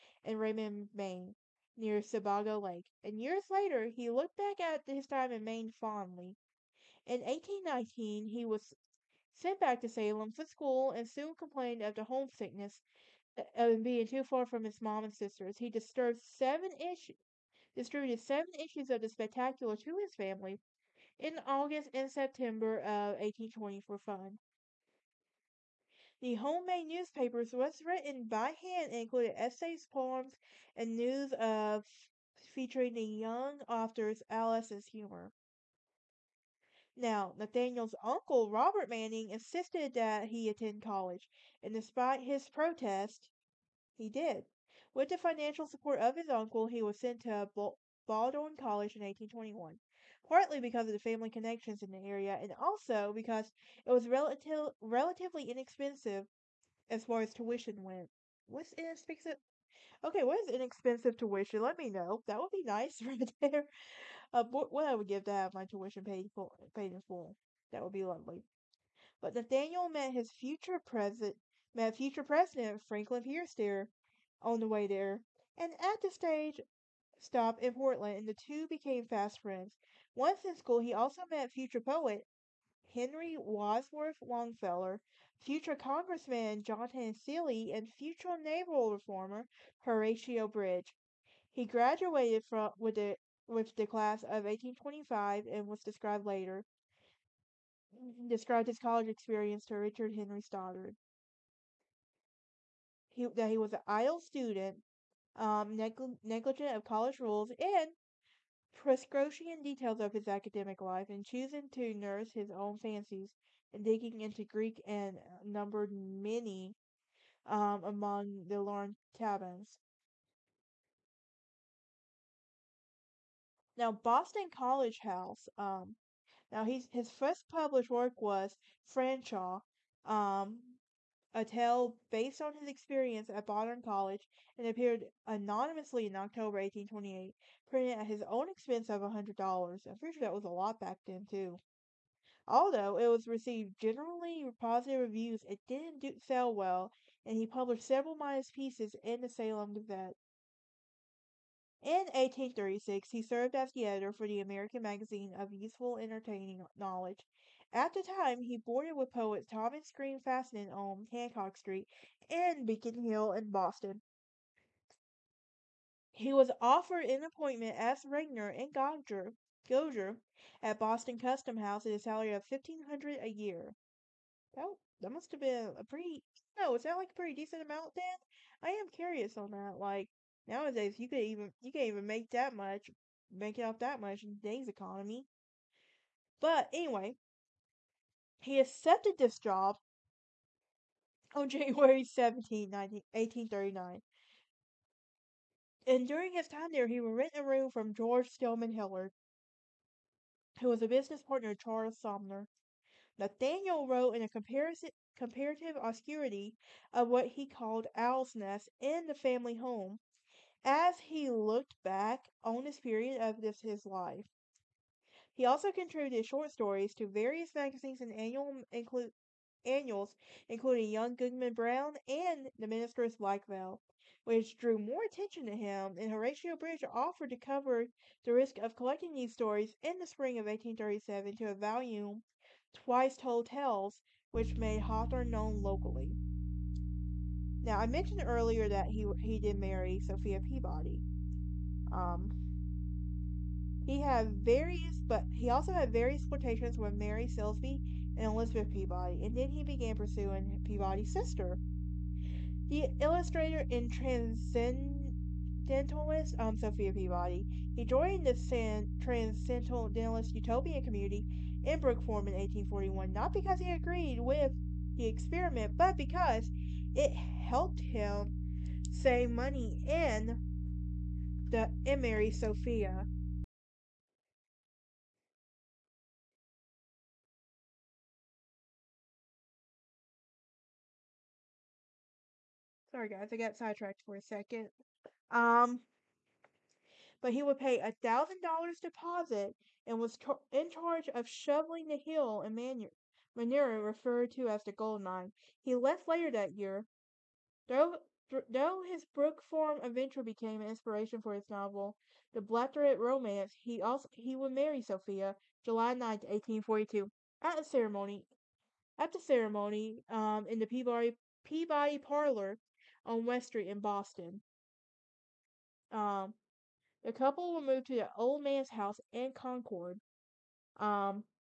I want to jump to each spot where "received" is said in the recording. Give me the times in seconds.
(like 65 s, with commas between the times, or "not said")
143 s.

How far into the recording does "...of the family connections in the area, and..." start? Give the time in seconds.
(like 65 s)
50 s.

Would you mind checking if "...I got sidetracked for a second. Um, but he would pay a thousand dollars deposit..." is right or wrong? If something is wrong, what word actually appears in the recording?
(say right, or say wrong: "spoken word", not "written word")
right.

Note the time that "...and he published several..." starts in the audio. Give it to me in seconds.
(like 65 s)
147 s.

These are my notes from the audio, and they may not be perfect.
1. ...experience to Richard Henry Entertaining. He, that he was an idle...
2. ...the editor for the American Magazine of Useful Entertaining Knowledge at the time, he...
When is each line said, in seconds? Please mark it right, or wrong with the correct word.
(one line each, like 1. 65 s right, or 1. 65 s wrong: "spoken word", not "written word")
1. 99 s wrong: "Stoddard", not "Entertaining"
2. 153 s right.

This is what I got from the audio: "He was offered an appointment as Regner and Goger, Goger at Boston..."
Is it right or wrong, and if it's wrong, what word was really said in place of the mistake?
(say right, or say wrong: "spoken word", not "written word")
right.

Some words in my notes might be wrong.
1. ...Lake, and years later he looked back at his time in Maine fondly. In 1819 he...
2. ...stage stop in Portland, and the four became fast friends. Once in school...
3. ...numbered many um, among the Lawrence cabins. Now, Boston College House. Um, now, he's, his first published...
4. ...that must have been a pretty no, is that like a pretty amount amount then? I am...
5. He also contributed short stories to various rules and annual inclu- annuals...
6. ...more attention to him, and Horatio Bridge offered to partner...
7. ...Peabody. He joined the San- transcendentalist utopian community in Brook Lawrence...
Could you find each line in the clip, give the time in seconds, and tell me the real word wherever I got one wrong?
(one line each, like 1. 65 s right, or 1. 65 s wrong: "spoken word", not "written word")
1. 2 s right
2. 76 s wrong: "two", not "four"
3. 115 s right
4. 175 s wrong: "decent", not "amount"
5. 215 s wrong: "magazines", not "rules"
6. 224 s wrong: "cover", not "partner"
7. 256 s wrong: "Farm", not "Lawrence".